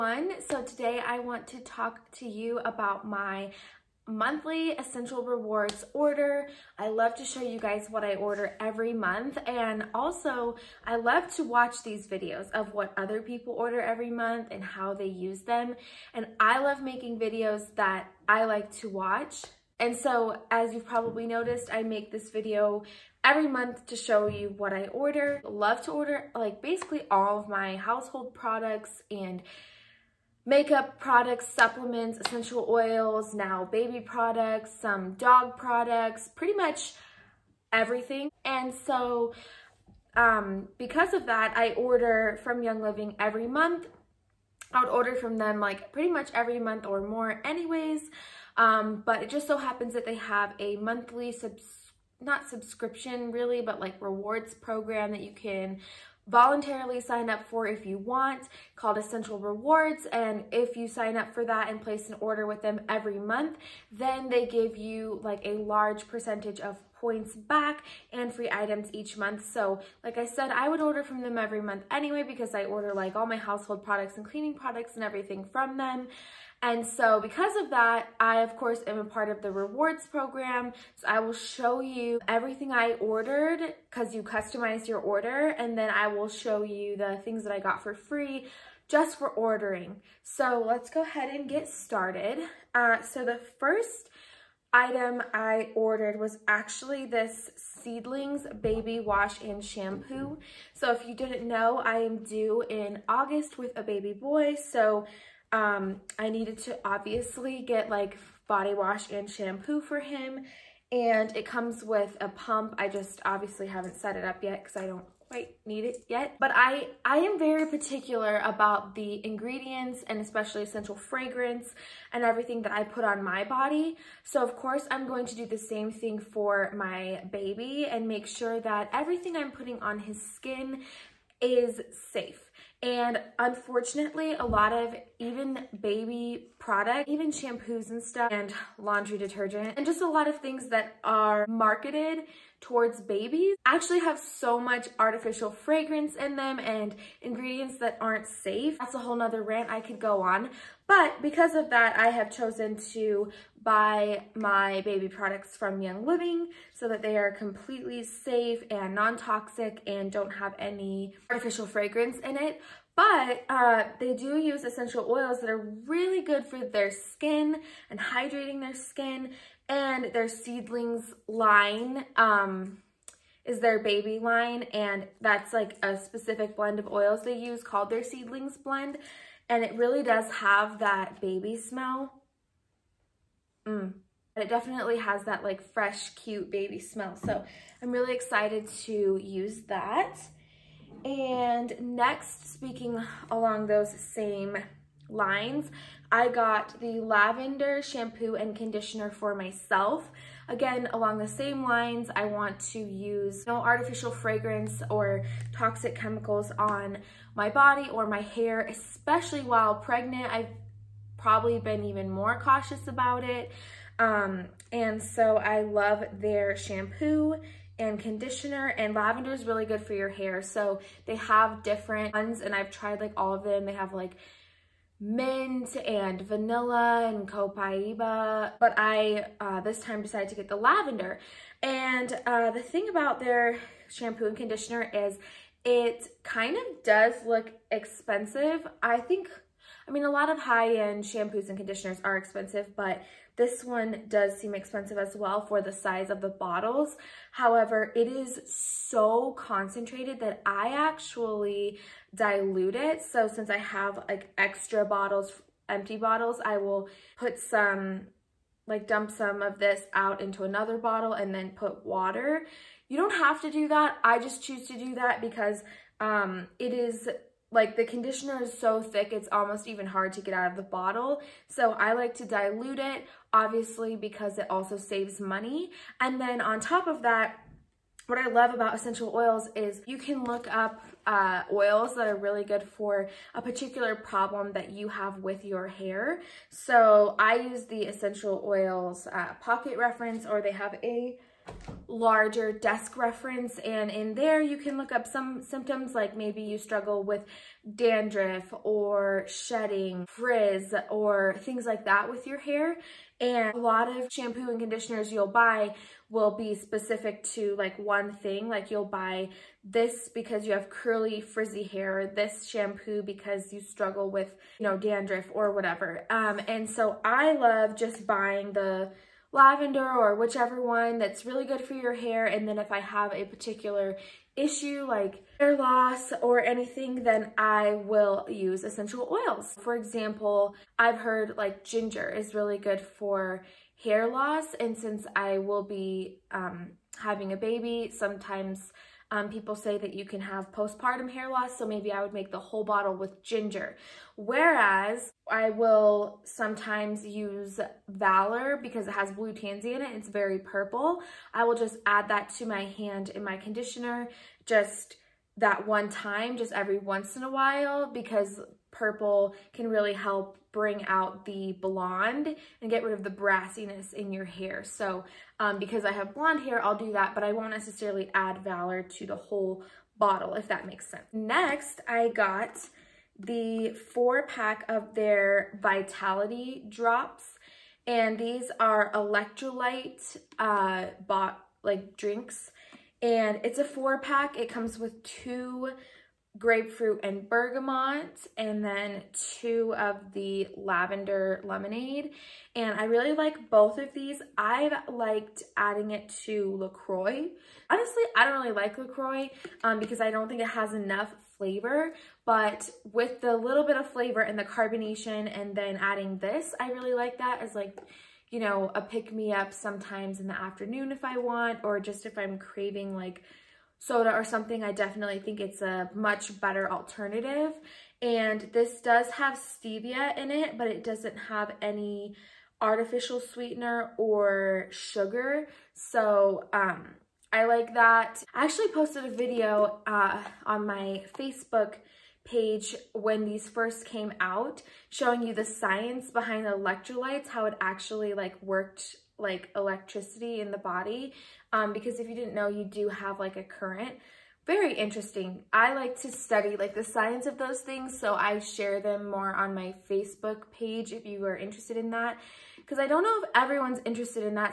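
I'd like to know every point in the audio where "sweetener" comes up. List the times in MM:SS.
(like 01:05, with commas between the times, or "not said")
07:03.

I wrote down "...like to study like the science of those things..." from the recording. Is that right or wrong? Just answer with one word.
right.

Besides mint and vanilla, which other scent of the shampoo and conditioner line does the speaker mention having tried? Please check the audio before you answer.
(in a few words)
Copaiba.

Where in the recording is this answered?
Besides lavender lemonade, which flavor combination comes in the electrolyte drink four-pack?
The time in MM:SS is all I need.
06:26.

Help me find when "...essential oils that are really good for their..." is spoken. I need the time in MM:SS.
02:44.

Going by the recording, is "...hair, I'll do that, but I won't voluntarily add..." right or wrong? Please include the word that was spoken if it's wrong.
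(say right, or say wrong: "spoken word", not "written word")
wrong: "necessarily", not "voluntarily".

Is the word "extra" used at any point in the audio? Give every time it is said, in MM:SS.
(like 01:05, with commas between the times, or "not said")
04:14.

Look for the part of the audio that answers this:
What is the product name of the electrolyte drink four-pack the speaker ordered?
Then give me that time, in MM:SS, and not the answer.
06:15.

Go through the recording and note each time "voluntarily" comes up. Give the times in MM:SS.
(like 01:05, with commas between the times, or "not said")
00:56.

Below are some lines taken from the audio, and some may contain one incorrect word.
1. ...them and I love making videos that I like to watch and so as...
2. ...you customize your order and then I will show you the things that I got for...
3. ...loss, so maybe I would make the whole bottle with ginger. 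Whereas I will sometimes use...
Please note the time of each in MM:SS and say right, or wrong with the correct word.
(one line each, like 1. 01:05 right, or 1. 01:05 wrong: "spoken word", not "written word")
1. 00:15 right
2. 01:24 right
3. 05:41 right.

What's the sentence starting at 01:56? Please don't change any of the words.
But I, I am very particular about the ingredients and especially essential fragrance and everything that I put on my body.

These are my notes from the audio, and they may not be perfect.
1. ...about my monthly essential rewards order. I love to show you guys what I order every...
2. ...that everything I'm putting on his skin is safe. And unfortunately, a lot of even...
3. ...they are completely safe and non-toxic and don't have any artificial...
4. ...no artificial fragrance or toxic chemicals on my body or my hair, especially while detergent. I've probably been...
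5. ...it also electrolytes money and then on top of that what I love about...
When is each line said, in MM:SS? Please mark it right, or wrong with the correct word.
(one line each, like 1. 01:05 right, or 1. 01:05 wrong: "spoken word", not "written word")
1. 00:02 right
2. 02:08 right
3. 02:37 right
4. 03:23 wrong: "pregnant", not "detergent"
5. 04:34 wrong: "saves", not "electrolytes".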